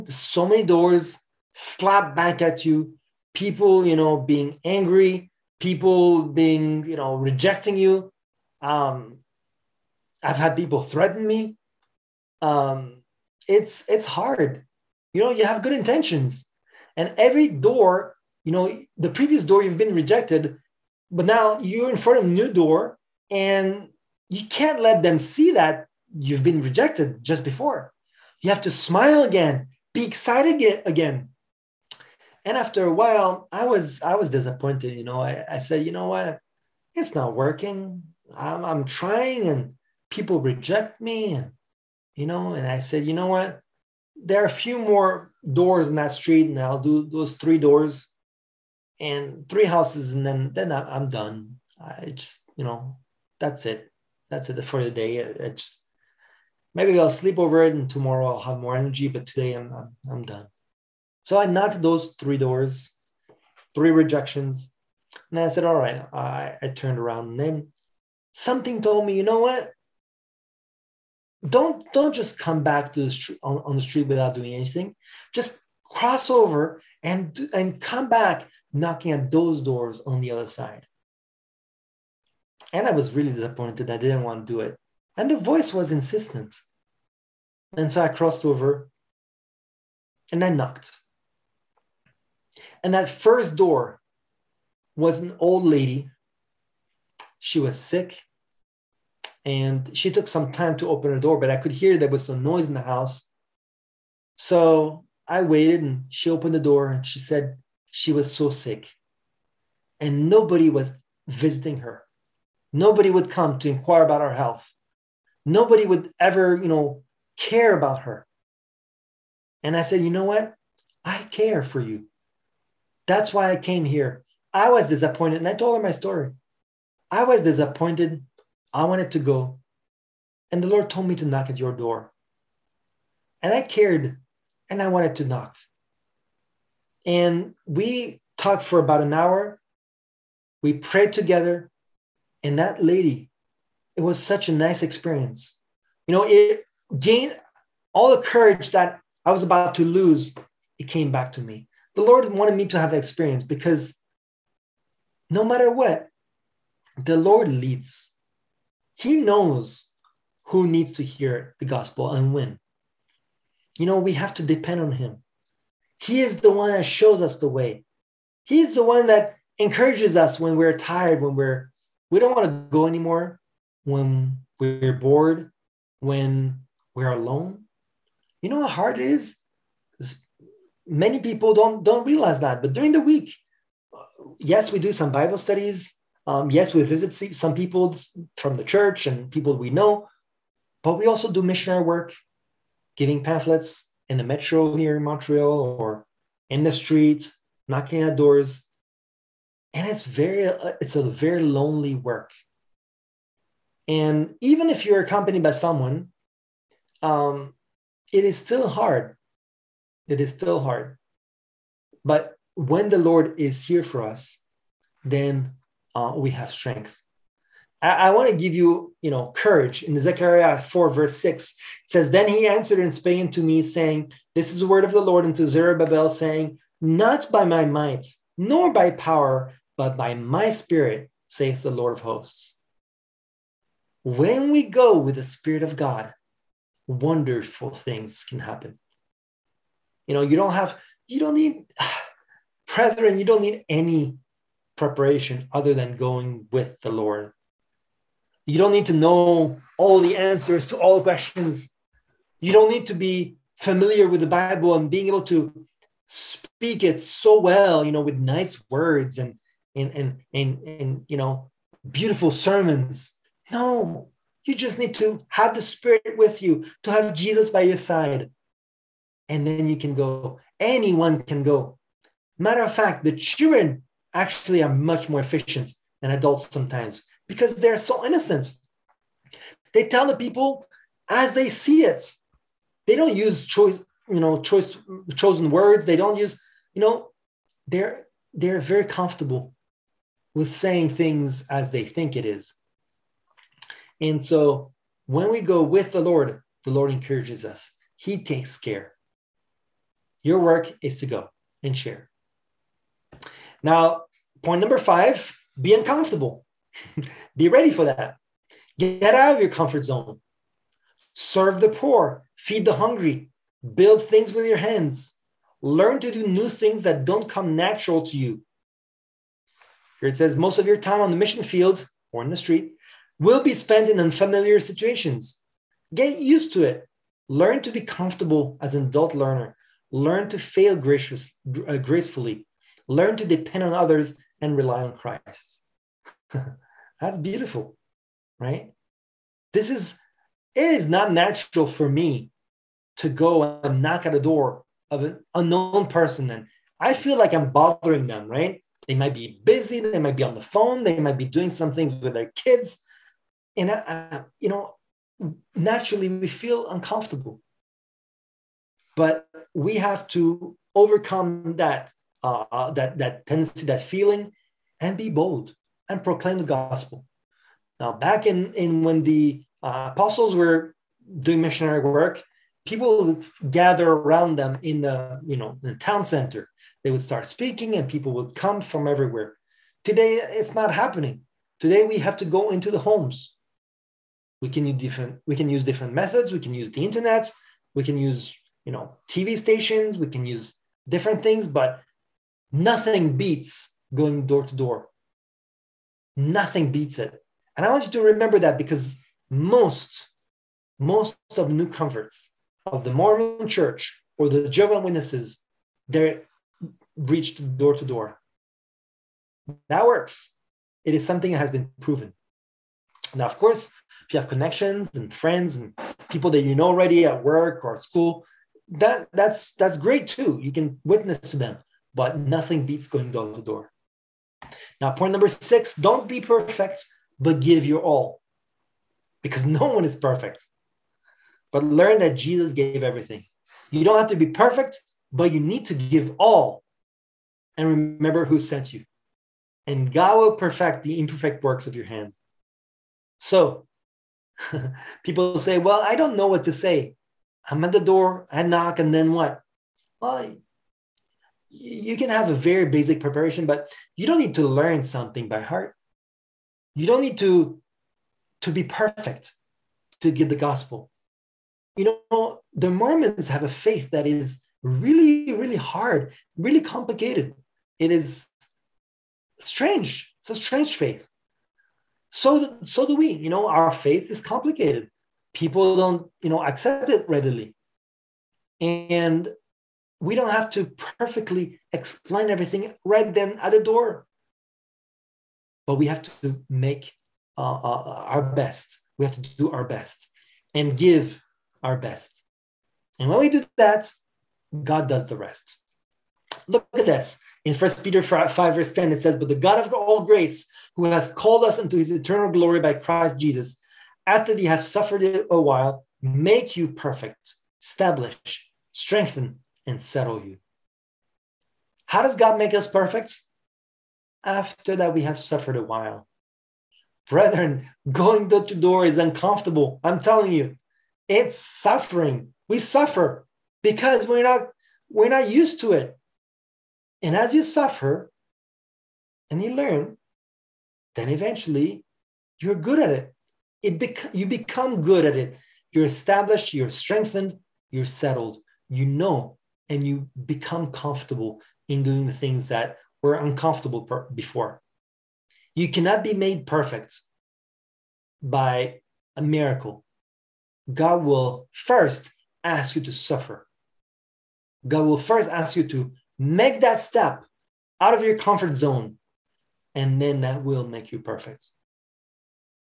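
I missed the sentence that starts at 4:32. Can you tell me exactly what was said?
Matter of fact, the children actually are much more efficient than adults sometimes because they're so innocent.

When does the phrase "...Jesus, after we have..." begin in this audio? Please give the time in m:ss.
8:23.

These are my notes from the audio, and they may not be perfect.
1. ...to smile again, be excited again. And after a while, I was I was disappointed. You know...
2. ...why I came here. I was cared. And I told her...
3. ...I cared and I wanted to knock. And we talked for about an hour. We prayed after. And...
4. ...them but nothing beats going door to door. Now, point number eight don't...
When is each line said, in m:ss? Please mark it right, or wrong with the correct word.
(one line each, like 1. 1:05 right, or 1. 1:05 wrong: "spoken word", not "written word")
1. 0:28 right
2. 2:03 wrong: "disappointed", not "cared"
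3. 2:13 wrong: "together", not "after"
4. 7:01 wrong: "six", not "eight".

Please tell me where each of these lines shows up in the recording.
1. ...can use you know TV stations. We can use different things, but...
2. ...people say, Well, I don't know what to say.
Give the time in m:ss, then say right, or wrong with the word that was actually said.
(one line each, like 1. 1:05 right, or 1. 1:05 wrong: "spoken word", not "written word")
1. 6:27 right
2. 7:25 right.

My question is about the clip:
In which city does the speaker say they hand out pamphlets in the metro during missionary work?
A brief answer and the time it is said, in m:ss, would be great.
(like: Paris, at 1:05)
Montreal, at 3:15.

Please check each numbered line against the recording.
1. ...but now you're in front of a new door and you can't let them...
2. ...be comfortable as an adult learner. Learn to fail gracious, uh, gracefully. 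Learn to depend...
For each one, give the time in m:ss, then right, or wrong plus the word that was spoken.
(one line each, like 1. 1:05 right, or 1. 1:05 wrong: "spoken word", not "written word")
1. 0:21 right
2. 5:27 right.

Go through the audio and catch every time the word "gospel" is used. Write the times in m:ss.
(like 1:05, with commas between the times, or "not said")
2:41, 6:06, 7:40.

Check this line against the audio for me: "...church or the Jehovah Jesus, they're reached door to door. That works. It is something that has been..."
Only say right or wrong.
wrong.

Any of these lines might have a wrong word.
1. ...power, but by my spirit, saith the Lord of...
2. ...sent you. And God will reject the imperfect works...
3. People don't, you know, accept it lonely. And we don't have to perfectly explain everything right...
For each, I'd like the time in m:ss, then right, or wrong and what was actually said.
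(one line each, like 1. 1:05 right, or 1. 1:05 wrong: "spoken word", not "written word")
1. 3:48 right
2. 7:18 wrong: "perfect", not "reject"
3. 7:55 wrong: "readily", not "lonely".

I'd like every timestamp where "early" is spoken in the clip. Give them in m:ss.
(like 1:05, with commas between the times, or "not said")
not said.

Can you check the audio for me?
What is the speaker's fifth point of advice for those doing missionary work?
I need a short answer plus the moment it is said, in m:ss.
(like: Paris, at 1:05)
Be uncomfortable, at 5:05.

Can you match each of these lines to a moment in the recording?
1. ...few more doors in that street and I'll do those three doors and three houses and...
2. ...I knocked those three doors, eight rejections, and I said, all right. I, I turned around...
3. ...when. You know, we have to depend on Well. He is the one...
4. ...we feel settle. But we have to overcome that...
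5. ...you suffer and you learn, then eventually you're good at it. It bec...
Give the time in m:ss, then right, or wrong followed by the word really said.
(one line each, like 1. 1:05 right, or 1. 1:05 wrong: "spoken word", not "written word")
1. 0:44 right
2. 1:01 wrong: "three", not "eight"
3. 2:42 wrong: "Him", not "Well"
4. 5:56 wrong: "uncomfortable", not "settle"
5. 8:47 right.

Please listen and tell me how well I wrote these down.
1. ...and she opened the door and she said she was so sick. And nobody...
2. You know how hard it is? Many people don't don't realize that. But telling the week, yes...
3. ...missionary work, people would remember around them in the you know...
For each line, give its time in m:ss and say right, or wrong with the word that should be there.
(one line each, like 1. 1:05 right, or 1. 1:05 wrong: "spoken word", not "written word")
1. 1:45 right
2. 2:58 wrong: "during", not "telling"
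3. 6:11 wrong: "gather", not "remember".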